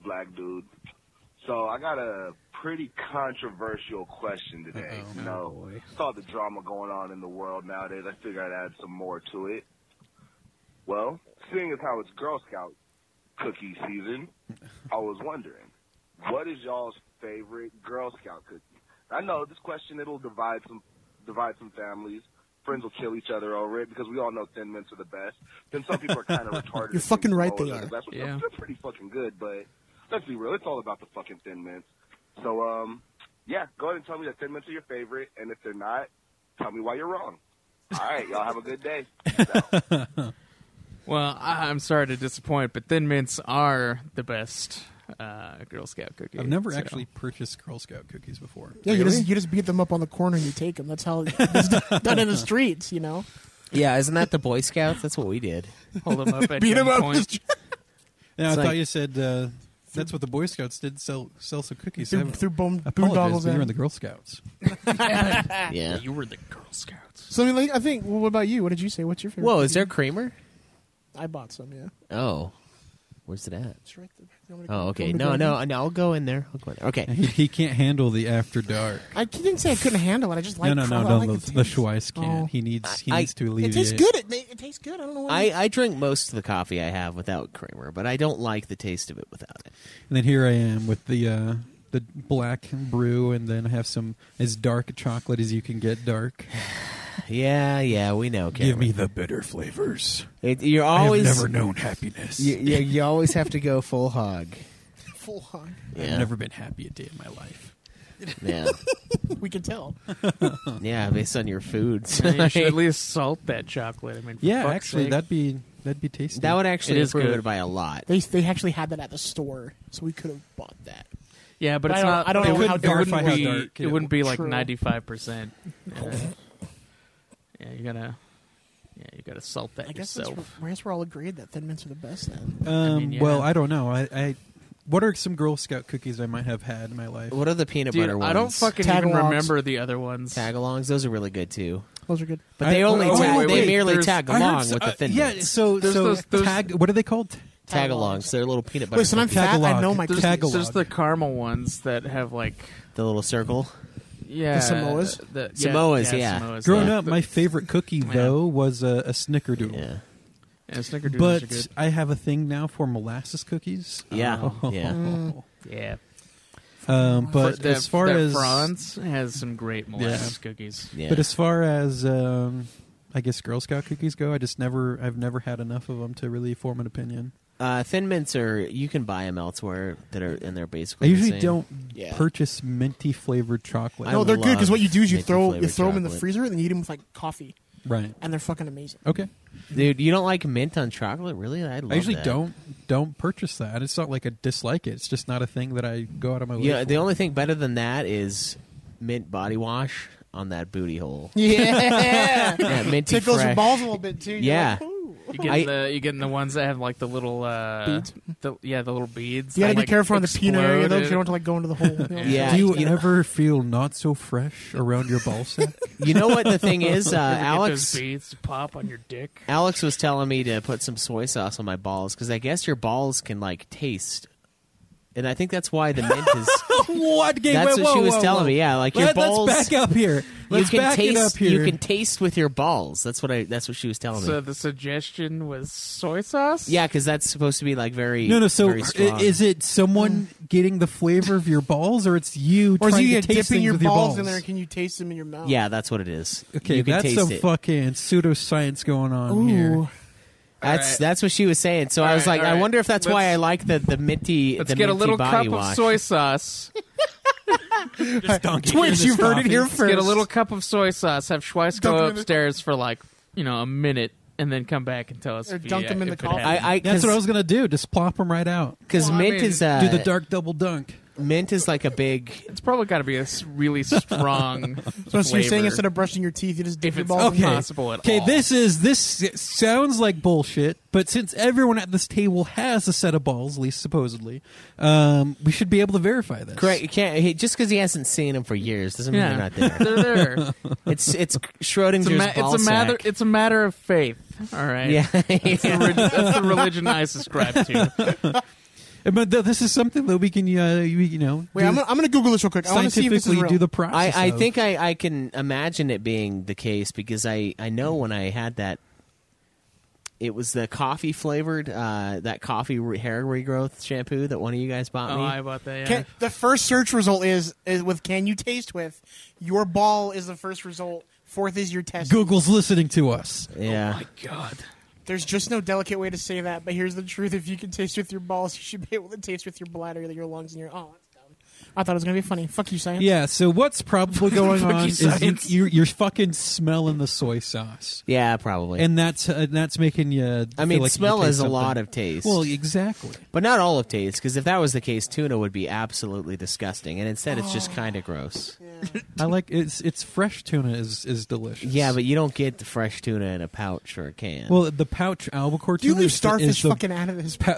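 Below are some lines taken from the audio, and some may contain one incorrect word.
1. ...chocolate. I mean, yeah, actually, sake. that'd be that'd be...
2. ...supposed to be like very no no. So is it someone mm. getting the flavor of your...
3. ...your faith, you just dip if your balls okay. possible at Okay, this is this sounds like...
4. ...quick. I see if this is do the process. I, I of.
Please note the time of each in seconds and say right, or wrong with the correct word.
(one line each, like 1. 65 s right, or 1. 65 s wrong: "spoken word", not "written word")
1. 113 s right
2. 237 s right
3. 276 s wrong: "teeth", not "faith"
4. 302 s right.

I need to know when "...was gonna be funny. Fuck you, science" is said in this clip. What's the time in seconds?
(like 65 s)
331 s.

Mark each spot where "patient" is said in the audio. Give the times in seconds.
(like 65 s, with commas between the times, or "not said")
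not said.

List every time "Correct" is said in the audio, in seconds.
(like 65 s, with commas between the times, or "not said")
286 s.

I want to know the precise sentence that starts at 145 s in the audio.
so There's so those- those- tag.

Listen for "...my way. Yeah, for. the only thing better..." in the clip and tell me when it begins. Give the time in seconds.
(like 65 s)
196 s.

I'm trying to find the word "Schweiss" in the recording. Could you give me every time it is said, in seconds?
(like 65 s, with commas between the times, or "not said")
81 s, 261 s.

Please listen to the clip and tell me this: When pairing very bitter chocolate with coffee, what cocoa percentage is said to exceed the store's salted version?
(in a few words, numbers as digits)
95 percent.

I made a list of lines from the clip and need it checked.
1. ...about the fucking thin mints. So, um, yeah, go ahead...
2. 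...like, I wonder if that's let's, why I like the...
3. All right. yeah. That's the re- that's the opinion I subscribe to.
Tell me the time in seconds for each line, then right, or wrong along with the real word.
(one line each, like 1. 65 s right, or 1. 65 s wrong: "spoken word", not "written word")
1. 30 s right
2. 252 s right
3. 294 s wrong: "religion", not "opinion".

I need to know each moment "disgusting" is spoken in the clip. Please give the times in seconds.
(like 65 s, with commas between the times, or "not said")
346 s.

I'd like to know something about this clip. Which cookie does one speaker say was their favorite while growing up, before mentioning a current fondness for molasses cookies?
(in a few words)
Snickerdoodle.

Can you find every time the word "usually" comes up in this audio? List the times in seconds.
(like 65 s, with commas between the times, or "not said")
181 s, 191 s.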